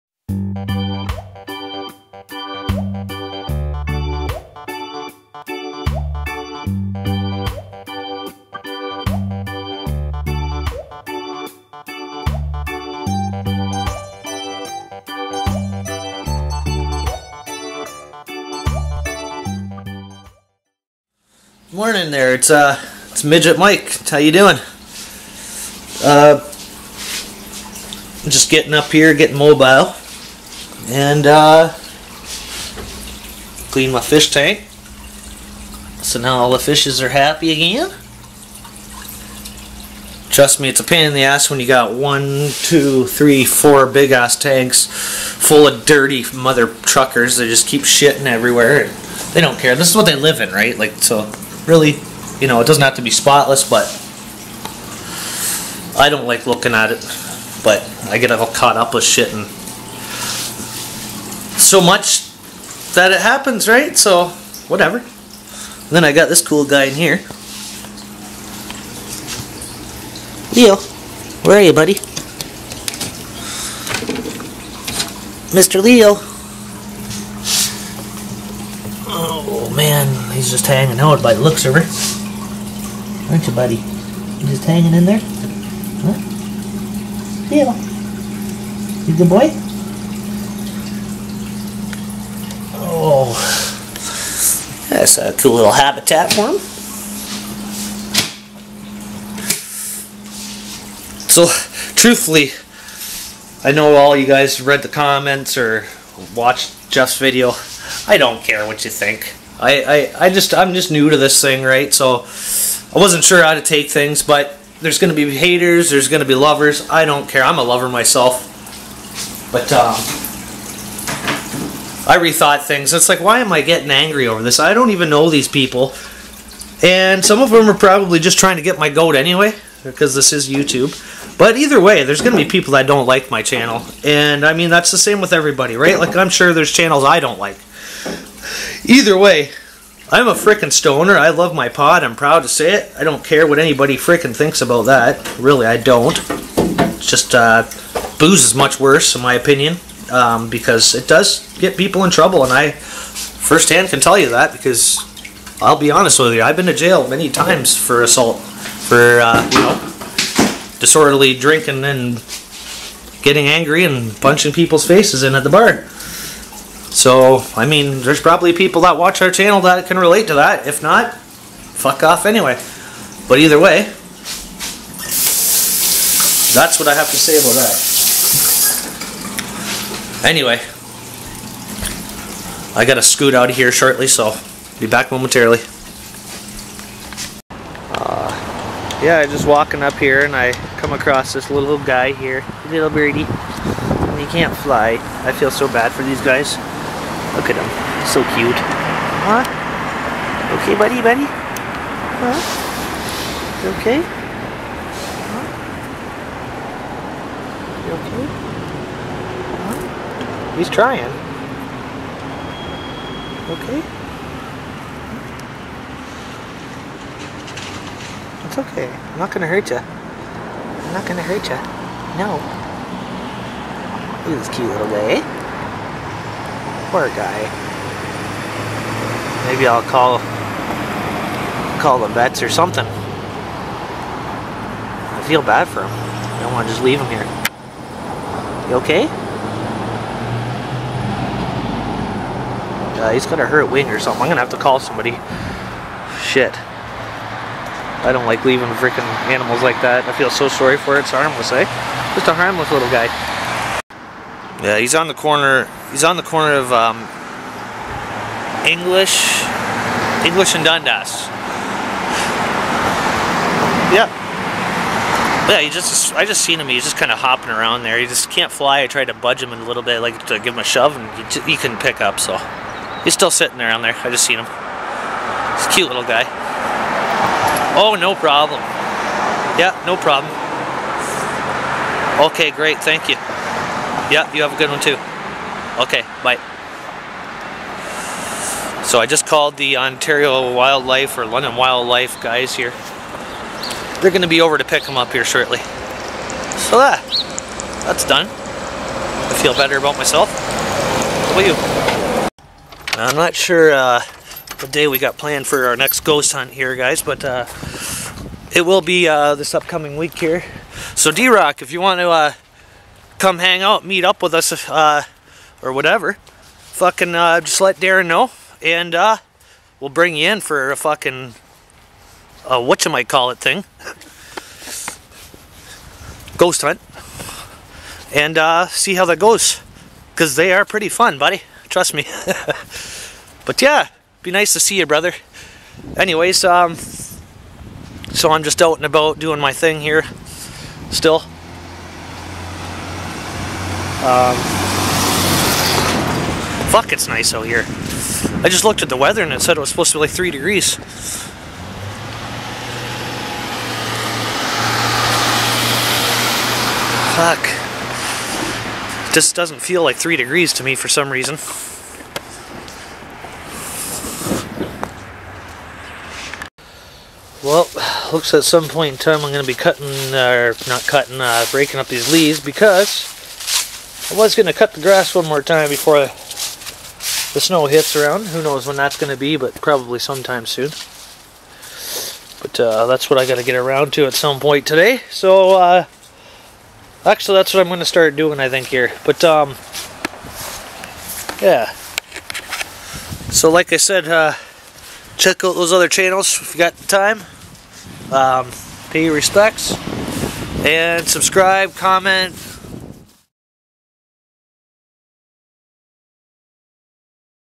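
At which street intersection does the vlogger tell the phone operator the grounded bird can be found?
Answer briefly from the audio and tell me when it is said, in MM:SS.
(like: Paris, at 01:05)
English and Dundas, at 04:20.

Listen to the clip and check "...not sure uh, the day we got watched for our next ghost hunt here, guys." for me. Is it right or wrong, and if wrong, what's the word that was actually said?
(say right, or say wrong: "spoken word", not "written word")
wrong: "planned", not "watched".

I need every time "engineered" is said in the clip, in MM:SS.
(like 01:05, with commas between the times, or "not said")
not said.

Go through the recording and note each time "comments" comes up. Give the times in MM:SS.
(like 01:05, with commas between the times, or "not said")
01:44, 06:41.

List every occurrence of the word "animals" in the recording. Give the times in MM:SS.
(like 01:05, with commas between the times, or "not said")
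04:09.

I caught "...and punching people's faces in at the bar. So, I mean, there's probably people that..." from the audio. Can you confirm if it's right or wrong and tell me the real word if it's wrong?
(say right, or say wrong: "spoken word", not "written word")
right.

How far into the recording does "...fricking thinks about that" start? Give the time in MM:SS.
02:23.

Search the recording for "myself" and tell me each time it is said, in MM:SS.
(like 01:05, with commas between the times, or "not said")
01:57, 04:59.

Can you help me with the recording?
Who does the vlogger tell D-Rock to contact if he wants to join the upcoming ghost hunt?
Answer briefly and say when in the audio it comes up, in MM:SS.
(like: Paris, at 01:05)
Darren, at 05:17.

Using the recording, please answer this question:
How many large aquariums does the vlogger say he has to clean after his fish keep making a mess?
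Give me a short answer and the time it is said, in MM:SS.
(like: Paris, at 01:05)
4, at 00:43.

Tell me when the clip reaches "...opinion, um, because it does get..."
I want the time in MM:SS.
02:29.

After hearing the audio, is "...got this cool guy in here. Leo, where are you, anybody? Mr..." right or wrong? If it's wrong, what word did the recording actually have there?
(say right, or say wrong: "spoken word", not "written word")
wrong: "buddy", not "anybody".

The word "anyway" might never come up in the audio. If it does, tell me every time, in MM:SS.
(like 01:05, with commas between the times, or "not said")
02:09, 02:52, 03:00, 05:35.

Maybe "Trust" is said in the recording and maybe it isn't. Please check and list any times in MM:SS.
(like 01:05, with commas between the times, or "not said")
00:40, 05:31.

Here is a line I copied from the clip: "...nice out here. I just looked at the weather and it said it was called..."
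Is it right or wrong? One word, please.
wrong.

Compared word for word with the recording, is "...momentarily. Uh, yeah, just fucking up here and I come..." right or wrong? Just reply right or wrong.
wrong.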